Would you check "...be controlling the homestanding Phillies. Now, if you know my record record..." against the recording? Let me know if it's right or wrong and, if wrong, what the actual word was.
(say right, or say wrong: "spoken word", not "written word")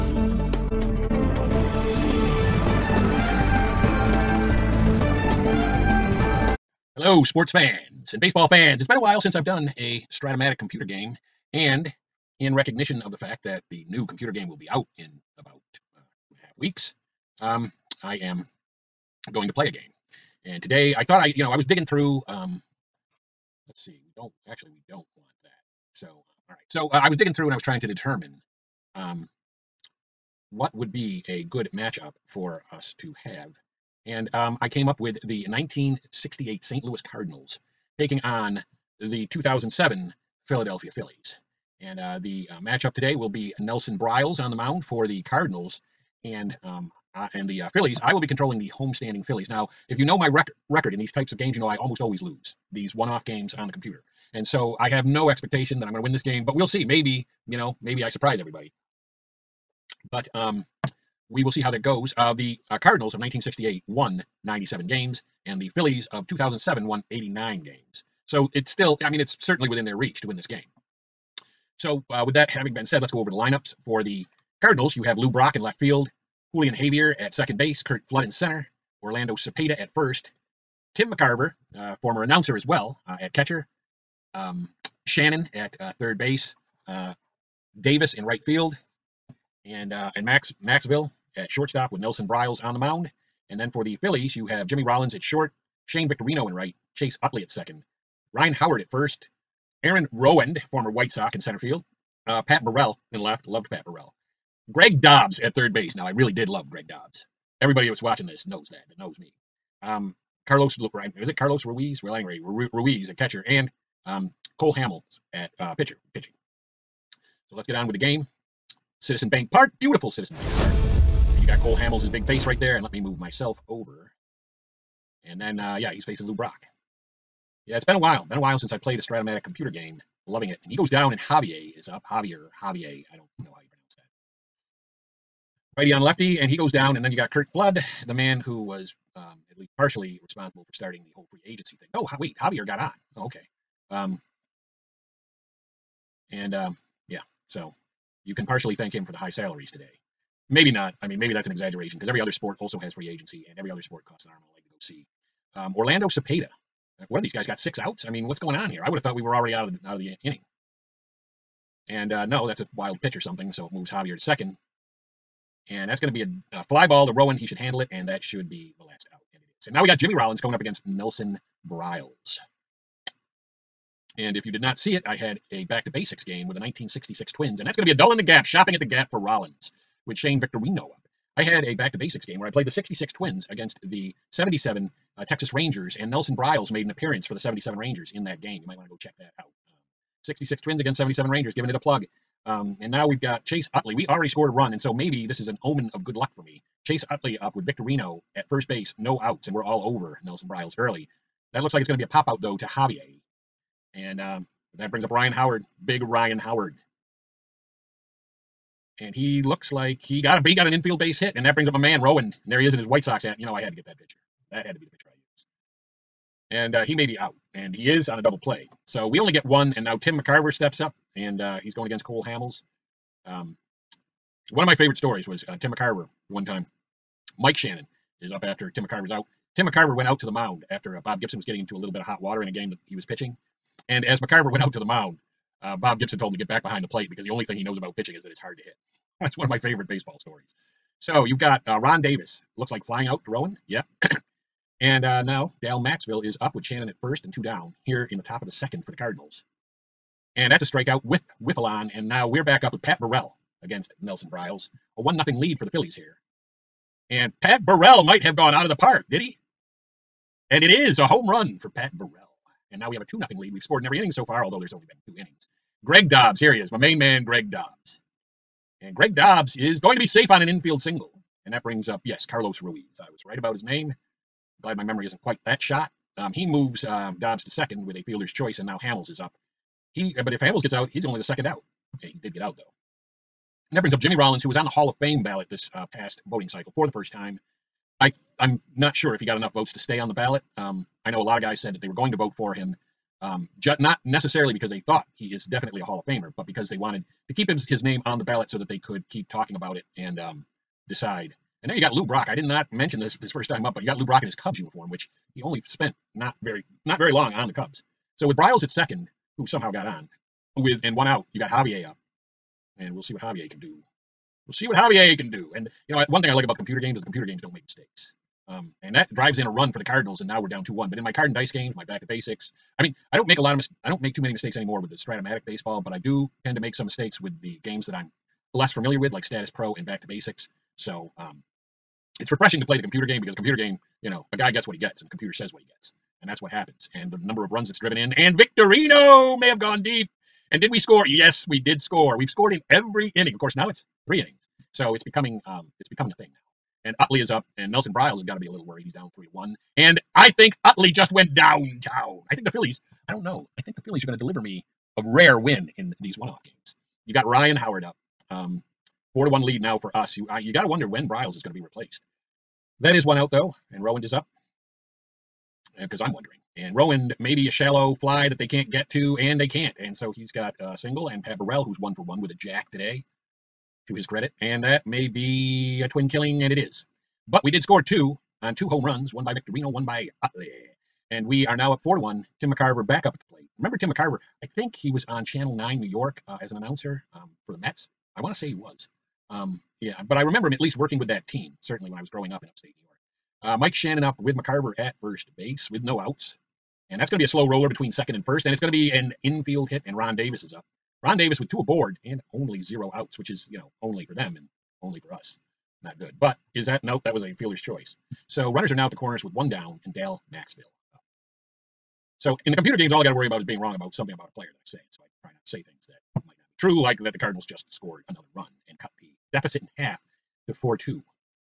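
right.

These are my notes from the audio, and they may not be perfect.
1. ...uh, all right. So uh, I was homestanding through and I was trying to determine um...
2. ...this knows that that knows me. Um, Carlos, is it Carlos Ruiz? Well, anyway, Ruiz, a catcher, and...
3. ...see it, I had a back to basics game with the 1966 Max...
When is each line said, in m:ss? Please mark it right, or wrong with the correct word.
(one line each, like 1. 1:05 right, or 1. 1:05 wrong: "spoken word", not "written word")
1. 0:26 wrong: "digging", not "homestanding"
2. 1:48 right
3. 2:54 wrong: "Twins", not "Max".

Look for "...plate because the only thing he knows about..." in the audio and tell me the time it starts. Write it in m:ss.
3:56.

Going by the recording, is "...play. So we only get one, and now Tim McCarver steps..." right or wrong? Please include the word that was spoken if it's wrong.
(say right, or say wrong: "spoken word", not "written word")
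right.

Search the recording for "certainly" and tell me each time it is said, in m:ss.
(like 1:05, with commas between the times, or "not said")
1:09, 6:31.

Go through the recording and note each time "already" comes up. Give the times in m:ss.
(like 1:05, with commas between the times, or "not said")
2:39, 3:14.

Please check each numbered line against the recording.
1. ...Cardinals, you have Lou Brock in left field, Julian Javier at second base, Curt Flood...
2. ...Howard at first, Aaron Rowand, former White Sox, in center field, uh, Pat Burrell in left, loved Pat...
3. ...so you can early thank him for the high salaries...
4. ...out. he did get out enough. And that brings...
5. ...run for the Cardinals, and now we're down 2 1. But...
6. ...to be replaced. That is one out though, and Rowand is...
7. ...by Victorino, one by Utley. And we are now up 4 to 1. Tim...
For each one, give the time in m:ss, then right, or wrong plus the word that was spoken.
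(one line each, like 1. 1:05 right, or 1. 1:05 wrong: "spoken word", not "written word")
1. 1:14 right
2. 1:38 right
3. 2:27 wrong: "partially", not "early"
4. 4:41 wrong: "though", not "enough"
5. 5:19 right
6. 6:01 right
7. 6:19 right.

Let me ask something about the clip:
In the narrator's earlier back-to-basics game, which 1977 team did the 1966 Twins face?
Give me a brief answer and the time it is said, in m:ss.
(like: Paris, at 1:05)
Texas Rangers, at 3:05.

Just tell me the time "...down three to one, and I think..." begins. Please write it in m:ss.
5:48.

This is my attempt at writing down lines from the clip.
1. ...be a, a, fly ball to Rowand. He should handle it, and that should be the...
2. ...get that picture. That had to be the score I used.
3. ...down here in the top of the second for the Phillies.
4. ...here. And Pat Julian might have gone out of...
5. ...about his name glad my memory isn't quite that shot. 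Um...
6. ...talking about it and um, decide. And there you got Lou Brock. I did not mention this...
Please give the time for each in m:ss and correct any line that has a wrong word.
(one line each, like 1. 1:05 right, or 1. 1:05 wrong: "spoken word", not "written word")
1. 2:46 right
2. 3:33 wrong: "picture", not "score"
3. 4:07 wrong: "Cardinals", not "Phillies"
4. 4:15 wrong: "Burrell", not "Julian"
5. 4:33 right
6. 4:59 right.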